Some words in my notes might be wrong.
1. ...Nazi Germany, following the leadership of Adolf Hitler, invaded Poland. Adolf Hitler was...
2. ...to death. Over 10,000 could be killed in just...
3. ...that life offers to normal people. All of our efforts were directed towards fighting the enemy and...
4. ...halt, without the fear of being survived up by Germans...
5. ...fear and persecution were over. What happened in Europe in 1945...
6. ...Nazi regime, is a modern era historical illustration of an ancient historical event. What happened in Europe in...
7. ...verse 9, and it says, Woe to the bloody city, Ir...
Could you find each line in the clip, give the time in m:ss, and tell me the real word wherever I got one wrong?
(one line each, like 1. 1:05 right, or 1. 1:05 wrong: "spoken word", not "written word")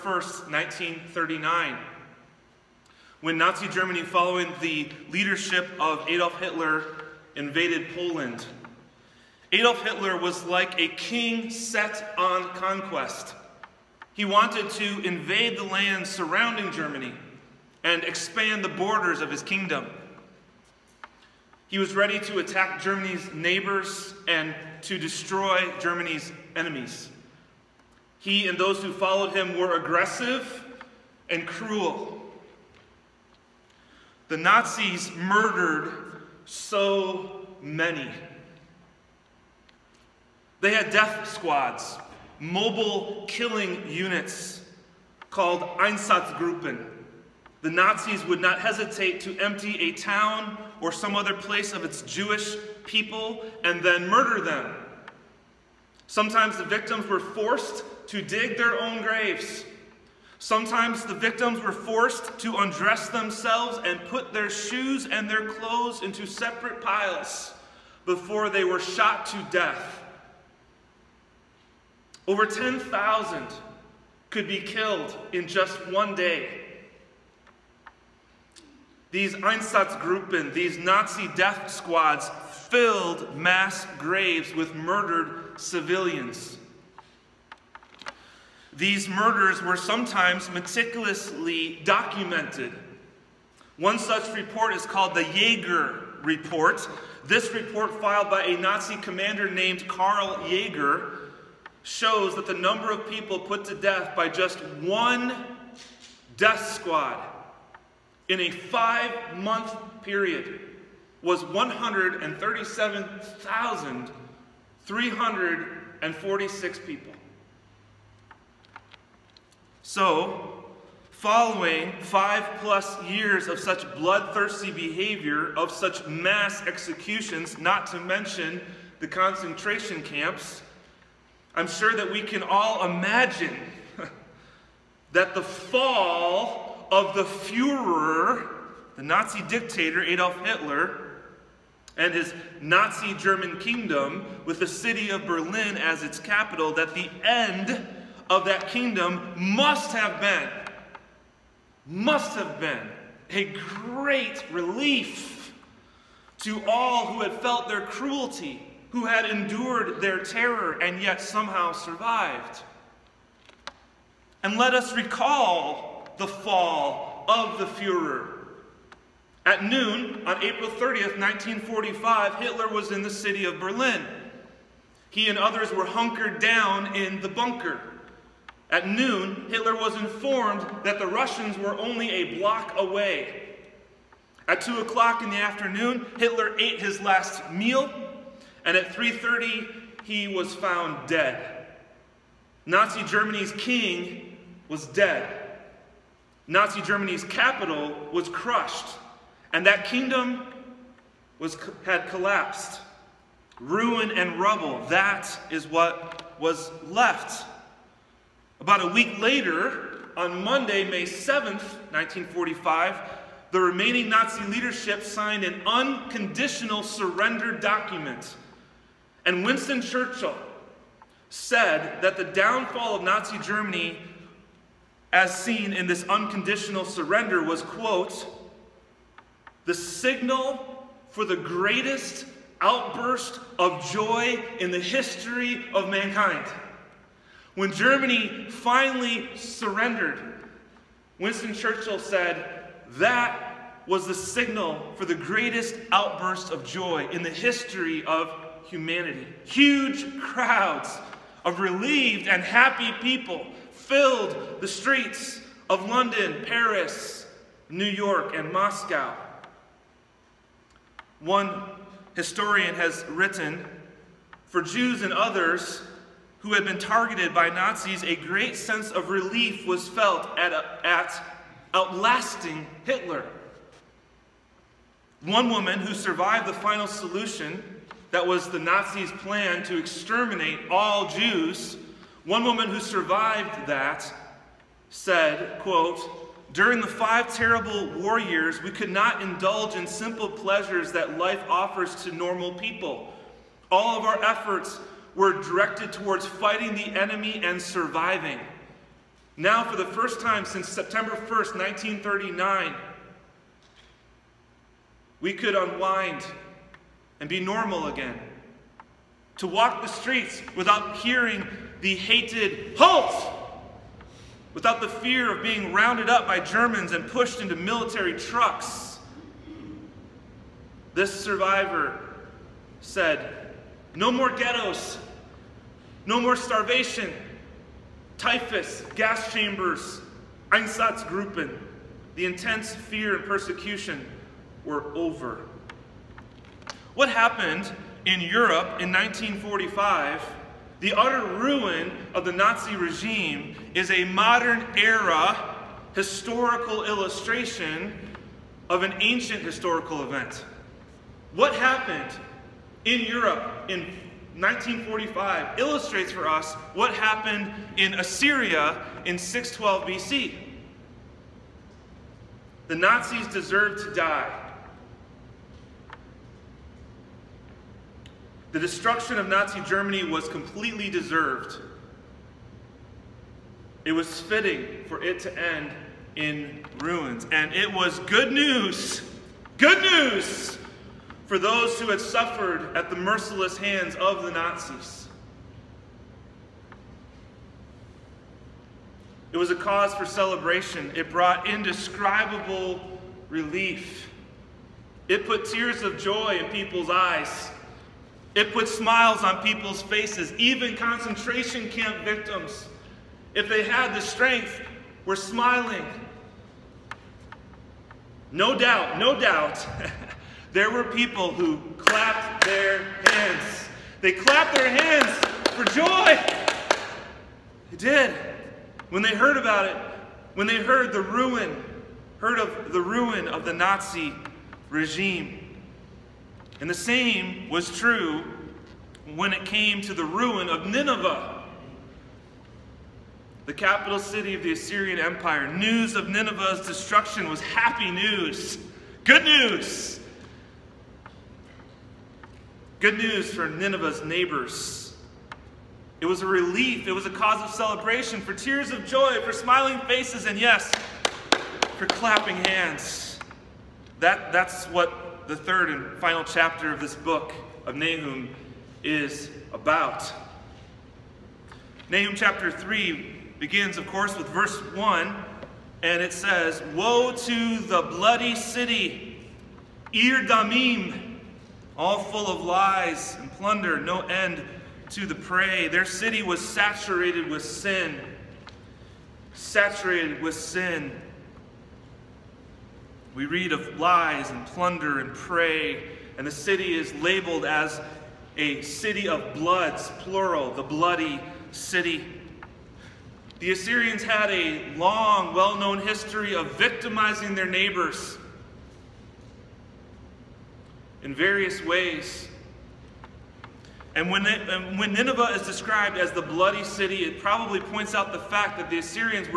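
1. 0:03 right
2. 1:09 right
3. 4:50 right
4. 5:12 wrong: "rounded", not "survived"
5. 5:32 right
6. 5:42 right
7. 7:44 wrong: "1", not "9".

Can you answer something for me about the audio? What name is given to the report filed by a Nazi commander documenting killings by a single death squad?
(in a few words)
Jaeger Report.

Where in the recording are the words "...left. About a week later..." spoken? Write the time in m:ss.
3:26.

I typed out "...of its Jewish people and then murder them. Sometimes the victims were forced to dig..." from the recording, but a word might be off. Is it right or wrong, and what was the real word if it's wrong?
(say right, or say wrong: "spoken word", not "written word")
right.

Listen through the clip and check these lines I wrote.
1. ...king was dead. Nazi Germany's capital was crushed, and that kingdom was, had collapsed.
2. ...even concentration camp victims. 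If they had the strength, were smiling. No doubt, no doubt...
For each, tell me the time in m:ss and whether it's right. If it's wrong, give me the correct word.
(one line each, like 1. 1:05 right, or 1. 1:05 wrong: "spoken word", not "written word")
1. 3:13 right
2. 6:40 right.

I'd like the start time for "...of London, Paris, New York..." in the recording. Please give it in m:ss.
4:15.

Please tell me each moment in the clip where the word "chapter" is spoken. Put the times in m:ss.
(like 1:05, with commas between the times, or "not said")
7:36, 7:42.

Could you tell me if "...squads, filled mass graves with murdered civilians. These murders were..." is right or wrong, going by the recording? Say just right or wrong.
right.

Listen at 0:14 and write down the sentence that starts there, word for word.
He wanted to invade the lands surrounding Germany and expand the borders of his kingdom.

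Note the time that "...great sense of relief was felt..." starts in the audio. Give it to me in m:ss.
4:28.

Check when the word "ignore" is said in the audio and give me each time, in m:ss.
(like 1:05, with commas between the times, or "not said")
not said.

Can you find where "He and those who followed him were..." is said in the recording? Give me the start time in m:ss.
0:28.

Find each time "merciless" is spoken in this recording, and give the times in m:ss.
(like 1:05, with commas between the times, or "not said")
6:22.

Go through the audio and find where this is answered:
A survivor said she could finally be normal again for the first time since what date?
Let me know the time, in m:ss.
5:00.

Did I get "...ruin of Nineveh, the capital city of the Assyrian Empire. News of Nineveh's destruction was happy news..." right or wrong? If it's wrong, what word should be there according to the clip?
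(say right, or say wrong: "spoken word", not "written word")
right.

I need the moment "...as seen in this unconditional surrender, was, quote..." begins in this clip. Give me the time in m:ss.
3:45.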